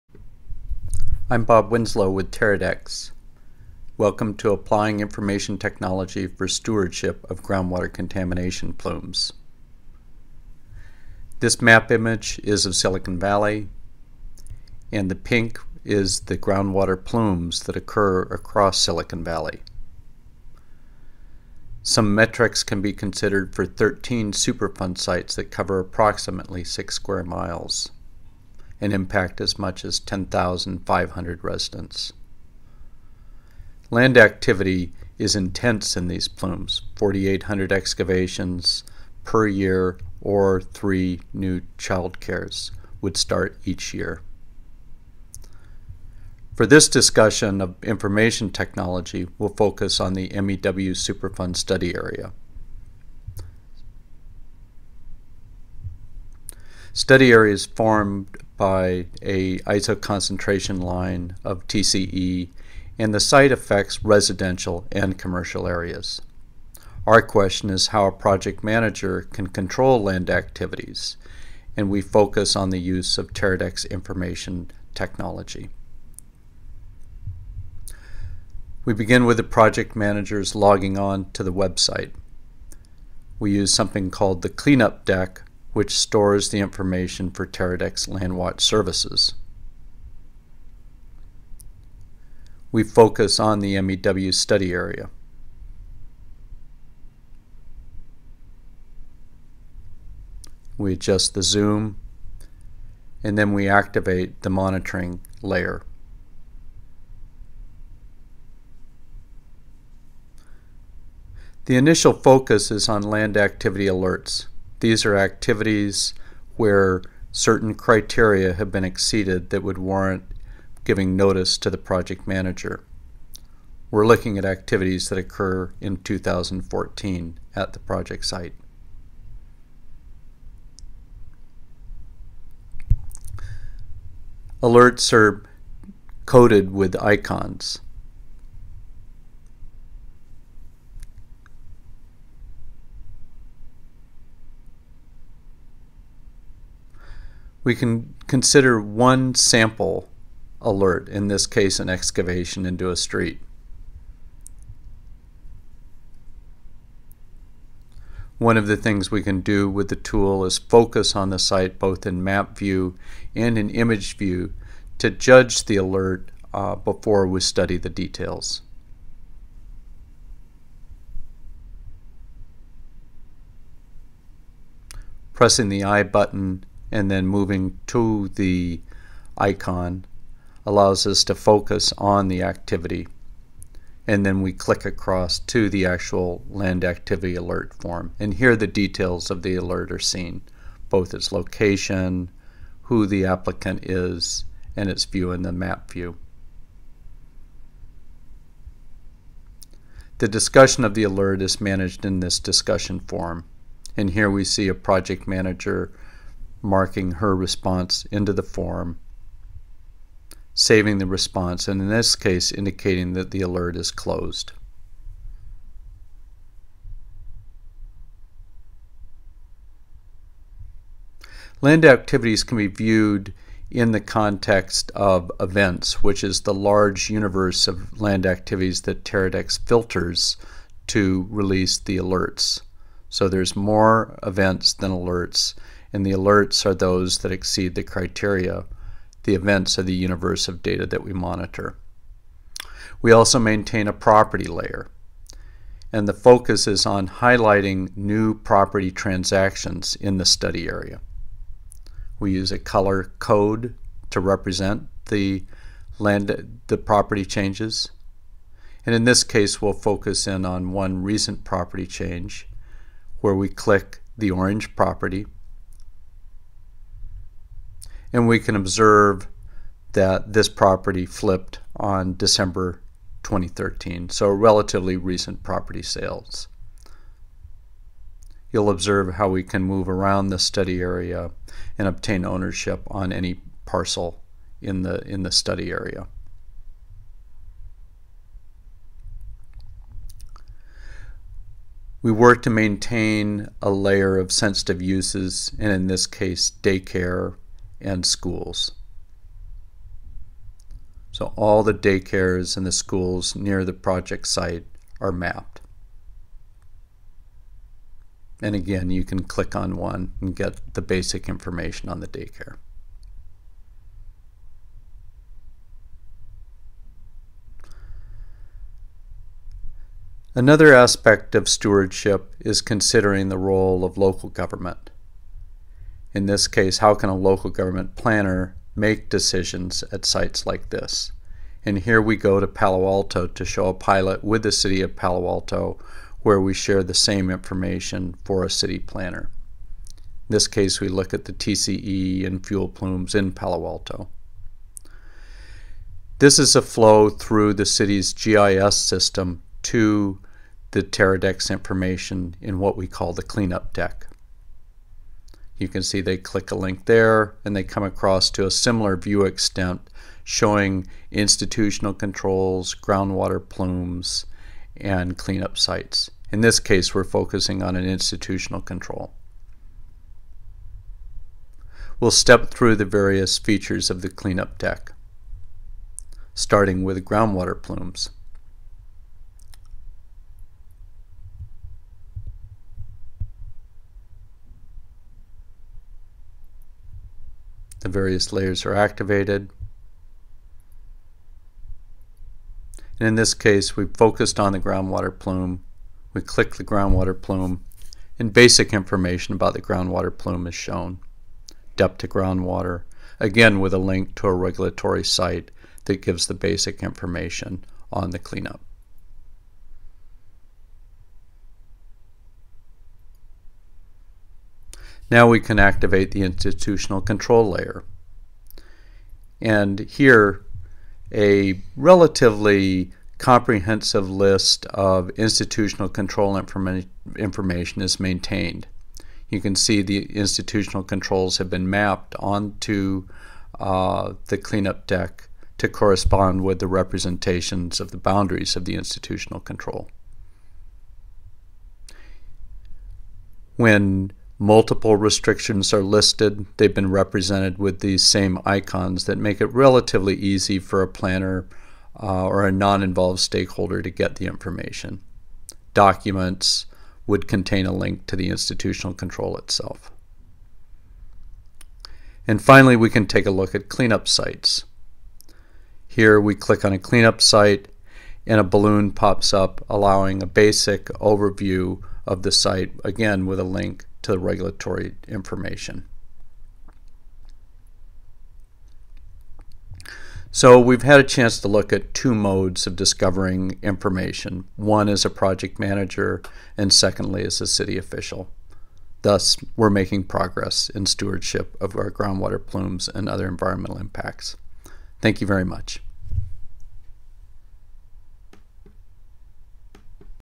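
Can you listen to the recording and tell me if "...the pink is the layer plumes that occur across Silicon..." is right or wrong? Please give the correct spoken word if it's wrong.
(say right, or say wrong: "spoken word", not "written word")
wrong: "groundwater", not "layer".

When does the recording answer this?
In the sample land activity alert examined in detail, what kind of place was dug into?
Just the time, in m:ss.
2:32.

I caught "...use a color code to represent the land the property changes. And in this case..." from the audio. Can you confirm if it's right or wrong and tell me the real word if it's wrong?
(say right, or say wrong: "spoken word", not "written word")
right.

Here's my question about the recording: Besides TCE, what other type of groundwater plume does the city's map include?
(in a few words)
fuel.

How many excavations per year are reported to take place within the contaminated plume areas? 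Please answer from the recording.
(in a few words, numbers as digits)
4,800.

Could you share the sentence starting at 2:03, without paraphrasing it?
We're looking at activities that occur in 2014 at the project site.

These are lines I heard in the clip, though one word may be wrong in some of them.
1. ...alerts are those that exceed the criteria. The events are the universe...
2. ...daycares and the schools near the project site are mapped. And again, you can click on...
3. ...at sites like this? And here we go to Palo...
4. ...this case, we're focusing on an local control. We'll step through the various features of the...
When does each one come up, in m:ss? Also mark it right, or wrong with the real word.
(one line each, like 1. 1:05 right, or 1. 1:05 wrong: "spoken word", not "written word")
1. 3:56 right
2. 5:01 right
3. 5:29 right
4. 6:06 wrong: "institutional", not "local".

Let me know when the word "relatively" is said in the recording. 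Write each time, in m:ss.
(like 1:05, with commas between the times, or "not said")
4:34, 7:01, 7:29.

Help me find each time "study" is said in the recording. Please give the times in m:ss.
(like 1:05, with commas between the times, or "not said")
0:51, 0:56, 1:34, 2:47, 4:10, 4:40, 4:45.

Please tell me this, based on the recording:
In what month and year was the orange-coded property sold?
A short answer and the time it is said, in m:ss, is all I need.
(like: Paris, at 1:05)
December 2013, at 4:32.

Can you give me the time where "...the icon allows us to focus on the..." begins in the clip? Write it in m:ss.
2:58.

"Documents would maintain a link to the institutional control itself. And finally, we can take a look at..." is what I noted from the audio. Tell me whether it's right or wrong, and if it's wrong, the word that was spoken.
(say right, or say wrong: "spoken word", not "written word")
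wrong: "contain", not "maintain".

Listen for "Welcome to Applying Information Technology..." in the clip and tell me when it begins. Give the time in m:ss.
0:03.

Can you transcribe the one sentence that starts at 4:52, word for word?
We work to maintain a layer of sensitive uses, and in this case, daycare and schools.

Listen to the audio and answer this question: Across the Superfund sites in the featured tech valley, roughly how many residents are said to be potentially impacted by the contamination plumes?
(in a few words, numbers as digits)
10,500.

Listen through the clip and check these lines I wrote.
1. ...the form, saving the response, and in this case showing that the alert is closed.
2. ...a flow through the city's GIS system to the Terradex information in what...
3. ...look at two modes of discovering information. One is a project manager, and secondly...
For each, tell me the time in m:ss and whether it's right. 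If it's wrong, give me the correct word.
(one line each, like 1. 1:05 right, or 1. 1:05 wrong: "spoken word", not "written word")
1. 3:28 wrong: "indicating", not "showing"
2. 5:46 right
3. 8:01 right.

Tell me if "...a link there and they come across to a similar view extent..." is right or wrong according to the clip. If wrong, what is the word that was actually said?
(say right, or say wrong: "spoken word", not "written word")
right.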